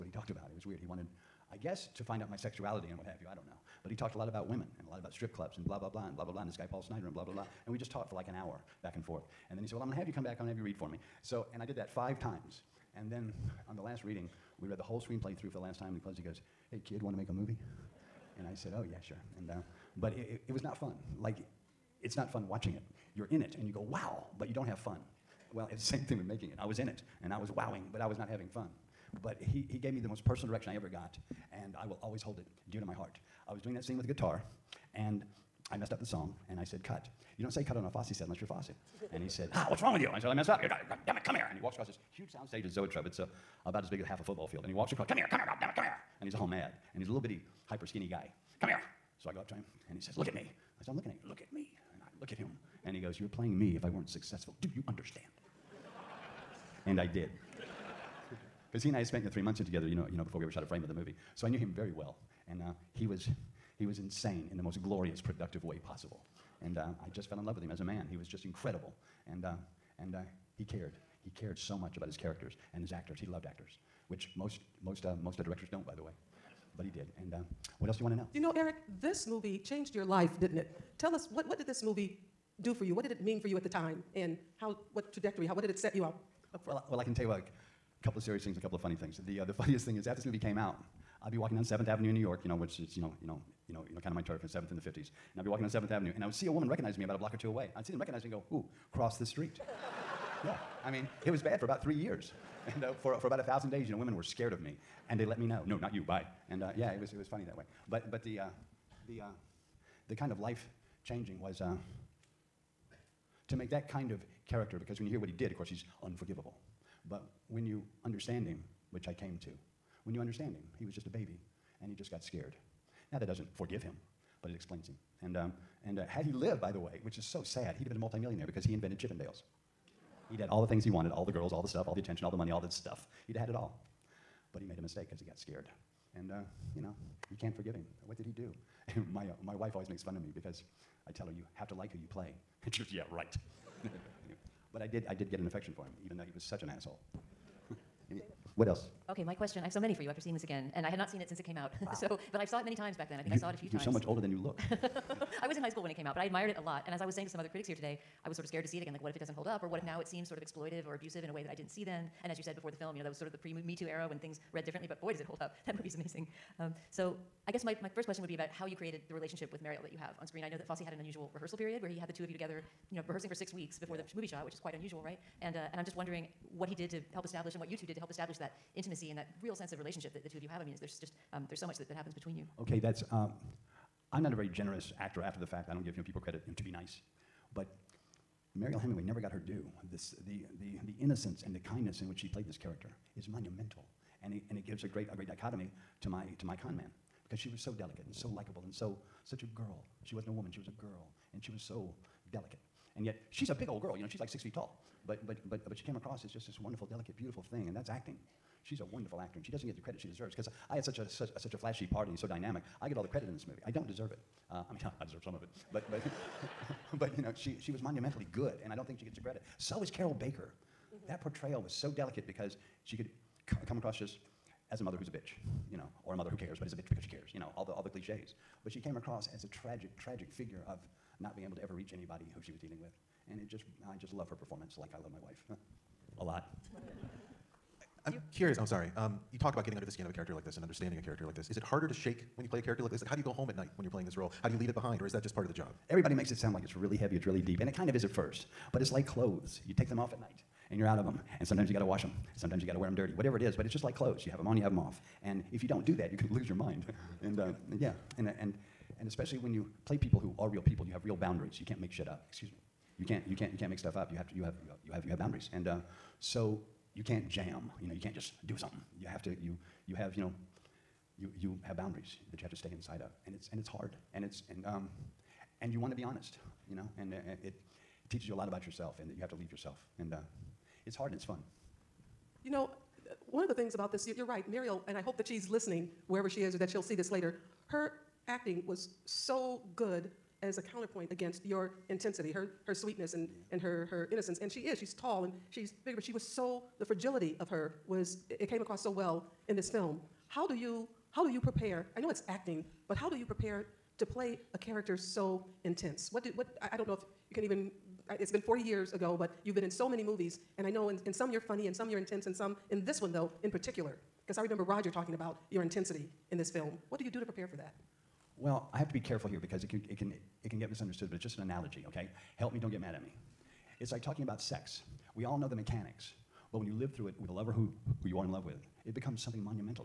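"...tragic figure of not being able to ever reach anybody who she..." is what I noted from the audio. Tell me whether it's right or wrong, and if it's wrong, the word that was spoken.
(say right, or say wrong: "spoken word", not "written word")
right.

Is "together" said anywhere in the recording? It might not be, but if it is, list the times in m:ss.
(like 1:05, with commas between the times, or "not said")
0:59, 2:52.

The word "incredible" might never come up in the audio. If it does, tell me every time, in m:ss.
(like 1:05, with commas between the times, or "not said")
1:08.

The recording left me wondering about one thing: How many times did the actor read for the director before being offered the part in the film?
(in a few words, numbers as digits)
5.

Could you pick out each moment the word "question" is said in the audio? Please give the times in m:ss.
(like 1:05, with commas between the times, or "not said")
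2:29, 2:48.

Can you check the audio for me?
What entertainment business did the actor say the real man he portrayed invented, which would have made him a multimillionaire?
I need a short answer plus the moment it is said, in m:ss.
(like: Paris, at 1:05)
Chippendales, at 2:08.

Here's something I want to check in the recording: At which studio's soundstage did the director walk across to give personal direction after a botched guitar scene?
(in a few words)
Zoetrope.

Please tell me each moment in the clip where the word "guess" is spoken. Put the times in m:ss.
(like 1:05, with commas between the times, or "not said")
0:01, 2:47.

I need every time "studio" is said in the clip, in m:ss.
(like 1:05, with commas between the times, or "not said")
not said.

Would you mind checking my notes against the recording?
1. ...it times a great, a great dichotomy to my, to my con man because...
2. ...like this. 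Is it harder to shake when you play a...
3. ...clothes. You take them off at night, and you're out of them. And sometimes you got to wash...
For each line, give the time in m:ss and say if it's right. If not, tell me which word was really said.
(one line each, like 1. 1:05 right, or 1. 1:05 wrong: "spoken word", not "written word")
1. 3:14 wrong: "gives", not "times"
2. 4:01 right
3. 4:09 right.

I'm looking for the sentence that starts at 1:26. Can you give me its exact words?
Well, well, I can tell you a couple of serious things and a couple of funny things.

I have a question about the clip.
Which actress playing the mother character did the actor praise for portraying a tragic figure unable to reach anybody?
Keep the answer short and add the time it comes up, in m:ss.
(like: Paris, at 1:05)
Carroll Baker, at 3:39.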